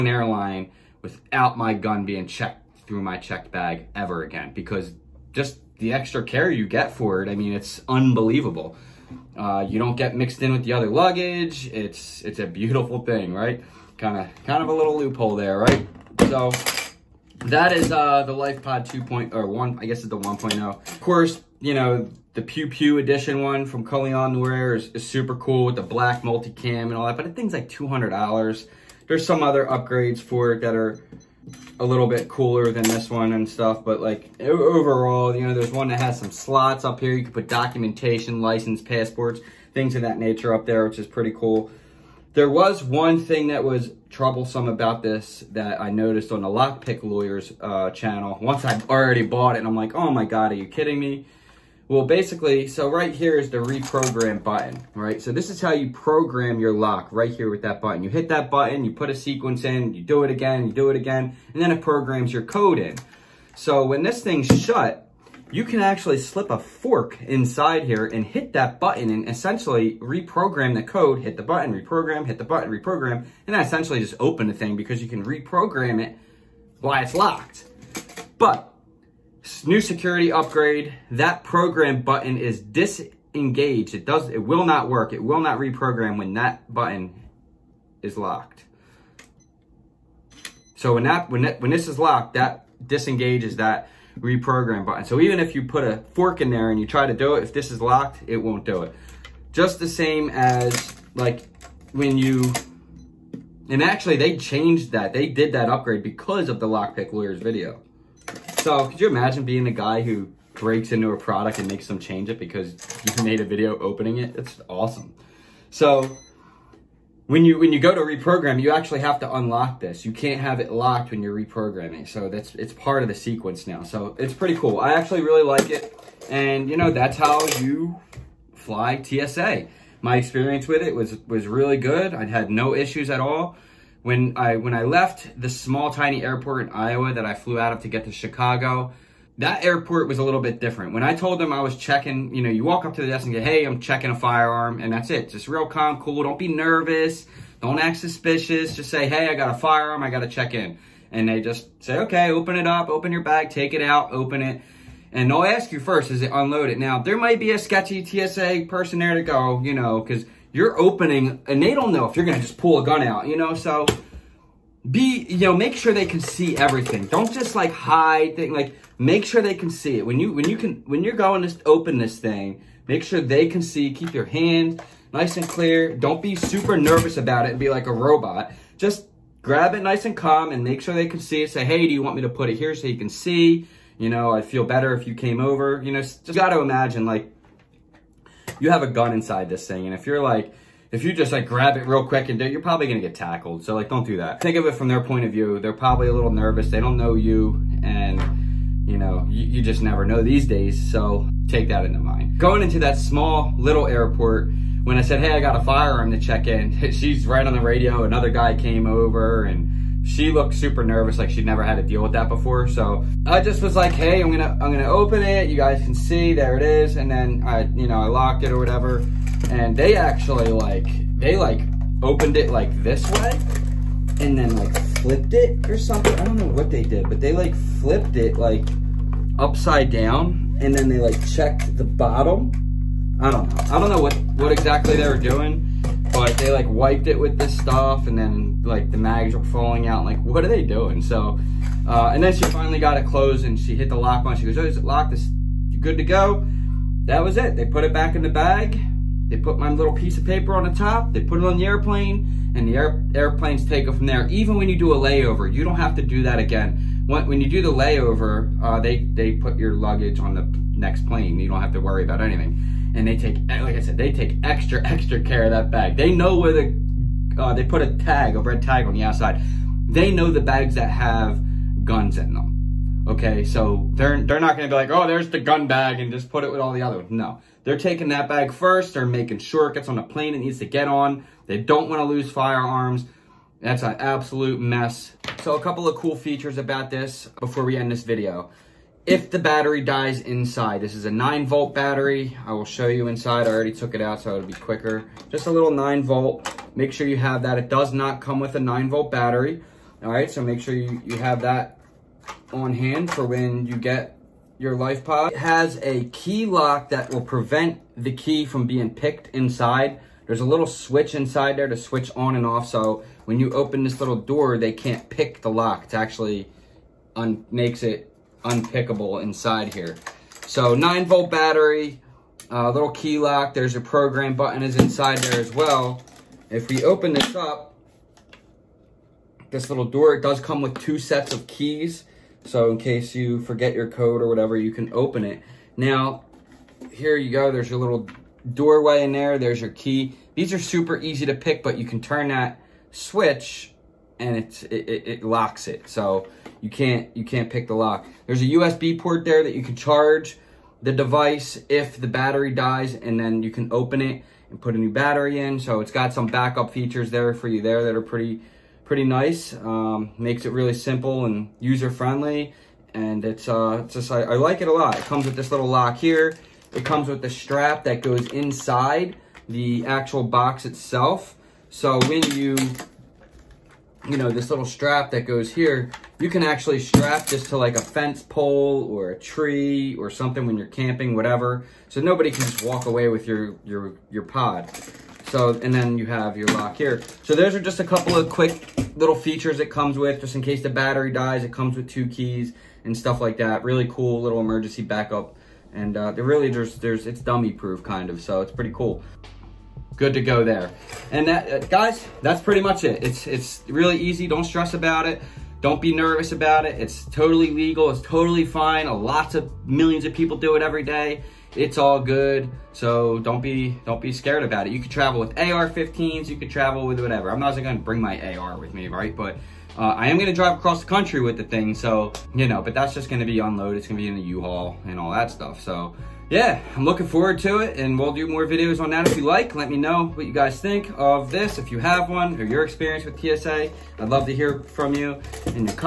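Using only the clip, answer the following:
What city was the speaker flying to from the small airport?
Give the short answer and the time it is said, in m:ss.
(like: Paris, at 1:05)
Chicago, at 2:18.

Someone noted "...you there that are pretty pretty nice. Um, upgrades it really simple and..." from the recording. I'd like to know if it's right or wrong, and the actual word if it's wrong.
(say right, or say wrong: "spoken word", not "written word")
wrong: "makes", not "upgrades".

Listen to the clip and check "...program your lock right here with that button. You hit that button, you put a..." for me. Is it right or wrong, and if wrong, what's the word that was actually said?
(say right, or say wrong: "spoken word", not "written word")
right.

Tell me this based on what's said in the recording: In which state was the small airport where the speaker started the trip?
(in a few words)
Iowa.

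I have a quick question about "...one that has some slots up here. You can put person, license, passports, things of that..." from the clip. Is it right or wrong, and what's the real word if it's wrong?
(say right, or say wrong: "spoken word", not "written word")
wrong: "documentation", not "person".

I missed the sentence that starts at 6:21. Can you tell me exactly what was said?
So nobody can just walk away with your, your, your pod.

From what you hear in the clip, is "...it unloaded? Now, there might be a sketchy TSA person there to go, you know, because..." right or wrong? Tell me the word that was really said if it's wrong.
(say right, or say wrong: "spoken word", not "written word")
right.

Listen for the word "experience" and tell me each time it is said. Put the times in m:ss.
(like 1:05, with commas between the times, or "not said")
2:10, 7:12.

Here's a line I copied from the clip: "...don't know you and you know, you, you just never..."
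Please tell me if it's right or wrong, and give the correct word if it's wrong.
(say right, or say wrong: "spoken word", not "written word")
right.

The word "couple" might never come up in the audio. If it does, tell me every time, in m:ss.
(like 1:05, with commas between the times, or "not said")
4:45, 6:27.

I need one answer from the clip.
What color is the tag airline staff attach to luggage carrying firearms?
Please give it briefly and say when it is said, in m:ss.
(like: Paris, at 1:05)
Red, at 4:28.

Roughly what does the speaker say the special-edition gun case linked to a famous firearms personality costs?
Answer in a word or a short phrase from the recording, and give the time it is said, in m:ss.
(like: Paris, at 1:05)
$200, at 0:27.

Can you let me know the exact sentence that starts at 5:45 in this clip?
So you can't, you can't pick the lock.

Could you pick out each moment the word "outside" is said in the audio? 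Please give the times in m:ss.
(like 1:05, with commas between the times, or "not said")
4:29.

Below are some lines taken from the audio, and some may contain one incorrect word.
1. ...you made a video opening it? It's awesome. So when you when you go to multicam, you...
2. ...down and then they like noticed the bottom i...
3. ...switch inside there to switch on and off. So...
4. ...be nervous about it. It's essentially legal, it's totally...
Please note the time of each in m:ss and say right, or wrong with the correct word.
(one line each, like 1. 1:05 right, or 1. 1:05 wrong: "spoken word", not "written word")
1. 1:53 wrong: "reprogram", not "multicam"
2. 3:49 wrong: "checked", not "noticed"
3. 5:10 right
4. 6:45 wrong: "totally", not "essentially".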